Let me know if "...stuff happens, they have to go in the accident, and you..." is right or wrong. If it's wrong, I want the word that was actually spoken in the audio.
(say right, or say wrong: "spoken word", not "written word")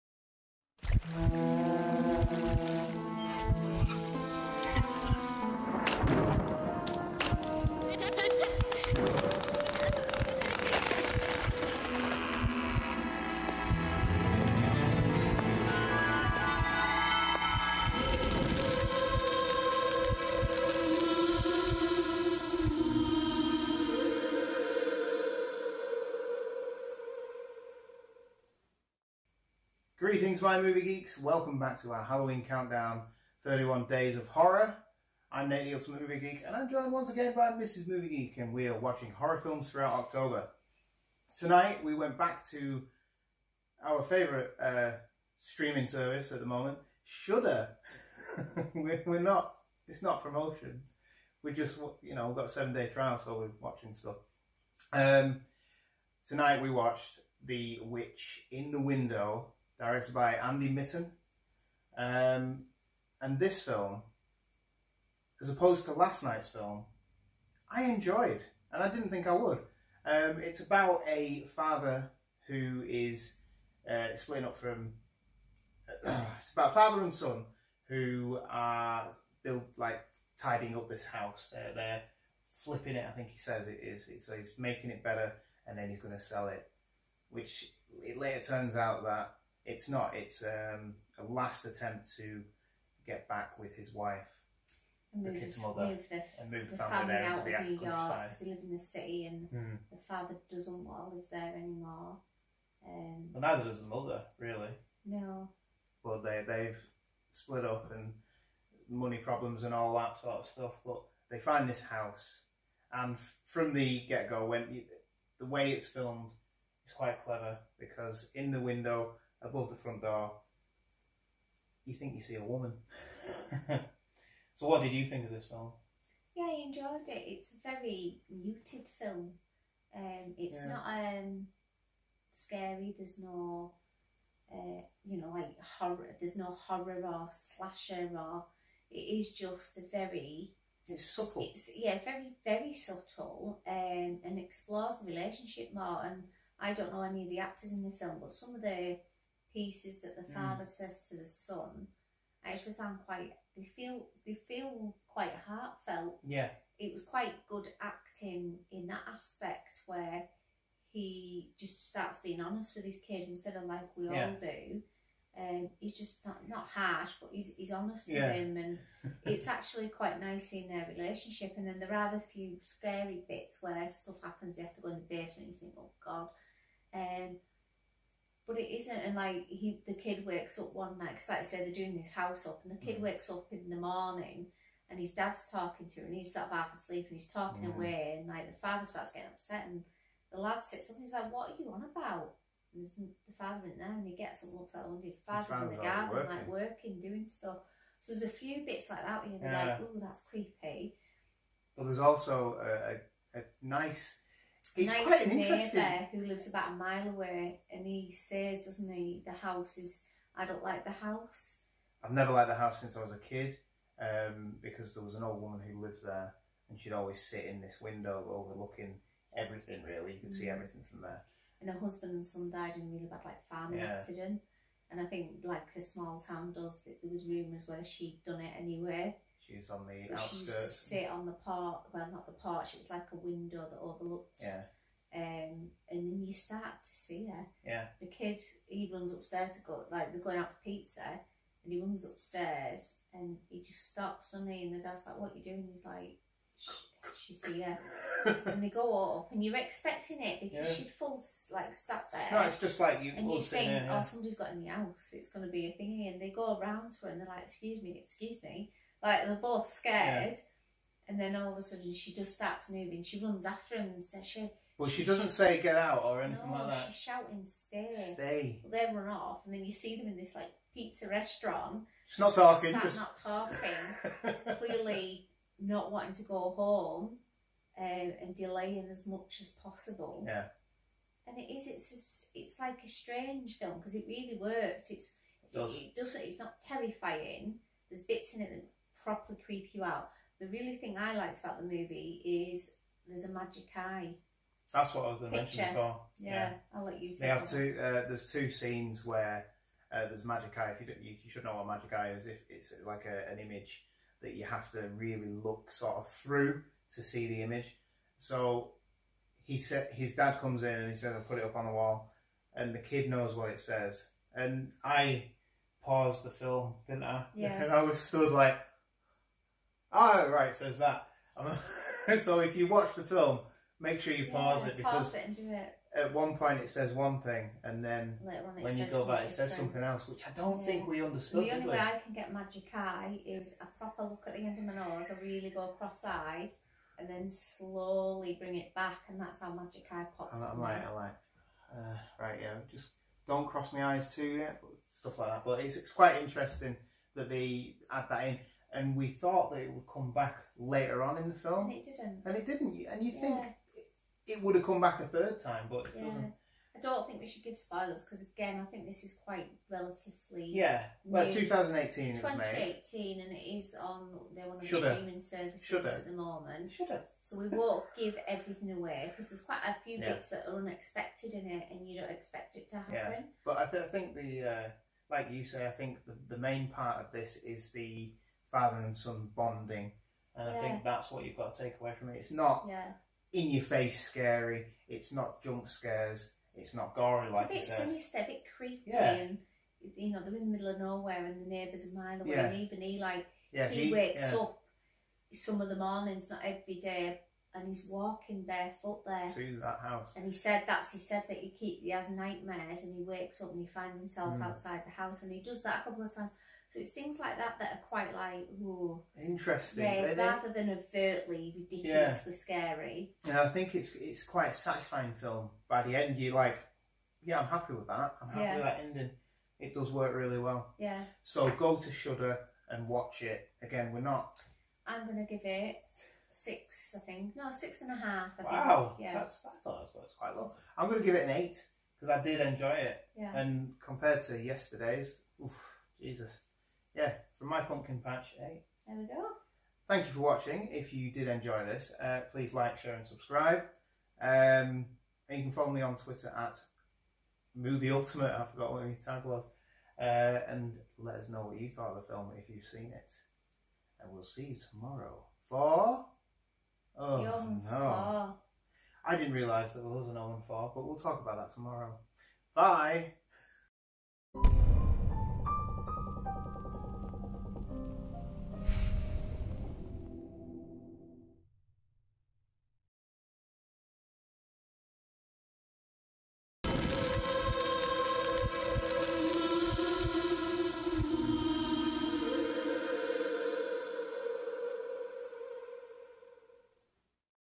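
wrong: "basement", not "accident".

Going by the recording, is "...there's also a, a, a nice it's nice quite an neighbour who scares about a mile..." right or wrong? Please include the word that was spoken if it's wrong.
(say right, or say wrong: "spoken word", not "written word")
wrong: "lives", not "scares".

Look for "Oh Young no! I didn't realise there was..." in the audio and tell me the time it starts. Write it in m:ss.
7:36.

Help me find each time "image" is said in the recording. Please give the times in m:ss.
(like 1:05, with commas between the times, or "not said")
5:03, 5:07.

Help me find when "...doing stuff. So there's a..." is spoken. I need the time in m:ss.
3:17.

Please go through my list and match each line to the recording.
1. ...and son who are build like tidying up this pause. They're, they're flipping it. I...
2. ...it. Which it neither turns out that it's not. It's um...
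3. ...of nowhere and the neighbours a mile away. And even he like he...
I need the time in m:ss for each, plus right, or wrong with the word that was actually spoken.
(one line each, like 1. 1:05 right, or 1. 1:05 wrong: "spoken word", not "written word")
1. 1:17 wrong: "house", not "pause"
2. 1:26 wrong: "later", not "neither"
3. 6:30 right.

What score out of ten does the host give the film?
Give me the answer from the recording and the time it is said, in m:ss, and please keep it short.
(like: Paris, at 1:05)
8, at 7:11.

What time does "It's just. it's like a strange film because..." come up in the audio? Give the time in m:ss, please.
4:41.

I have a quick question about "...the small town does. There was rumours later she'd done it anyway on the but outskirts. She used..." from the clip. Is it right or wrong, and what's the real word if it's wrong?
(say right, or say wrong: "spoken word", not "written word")
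wrong: "whether", not "later".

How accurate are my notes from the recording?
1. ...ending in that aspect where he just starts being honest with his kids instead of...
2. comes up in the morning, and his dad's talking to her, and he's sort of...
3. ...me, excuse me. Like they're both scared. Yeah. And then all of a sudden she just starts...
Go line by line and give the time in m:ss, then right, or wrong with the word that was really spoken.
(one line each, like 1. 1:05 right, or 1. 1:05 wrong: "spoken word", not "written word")
1. 2:37 wrong: "acting", not "ending"
2. 3:03 wrong: "wakes", not "comes"
3. 4:17 right.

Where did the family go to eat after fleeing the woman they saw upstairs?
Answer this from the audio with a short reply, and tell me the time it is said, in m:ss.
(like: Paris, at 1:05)
pizza restaurant, at 4:30.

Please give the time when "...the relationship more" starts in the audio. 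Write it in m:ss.
2:24.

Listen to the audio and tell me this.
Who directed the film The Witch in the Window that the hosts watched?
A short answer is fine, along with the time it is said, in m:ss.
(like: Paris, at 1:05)
Andy Mitten, at 1:00.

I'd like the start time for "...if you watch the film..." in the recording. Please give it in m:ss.
5:22.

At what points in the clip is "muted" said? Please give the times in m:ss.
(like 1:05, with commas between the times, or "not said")
2:08.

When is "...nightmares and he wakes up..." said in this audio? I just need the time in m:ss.
6:42.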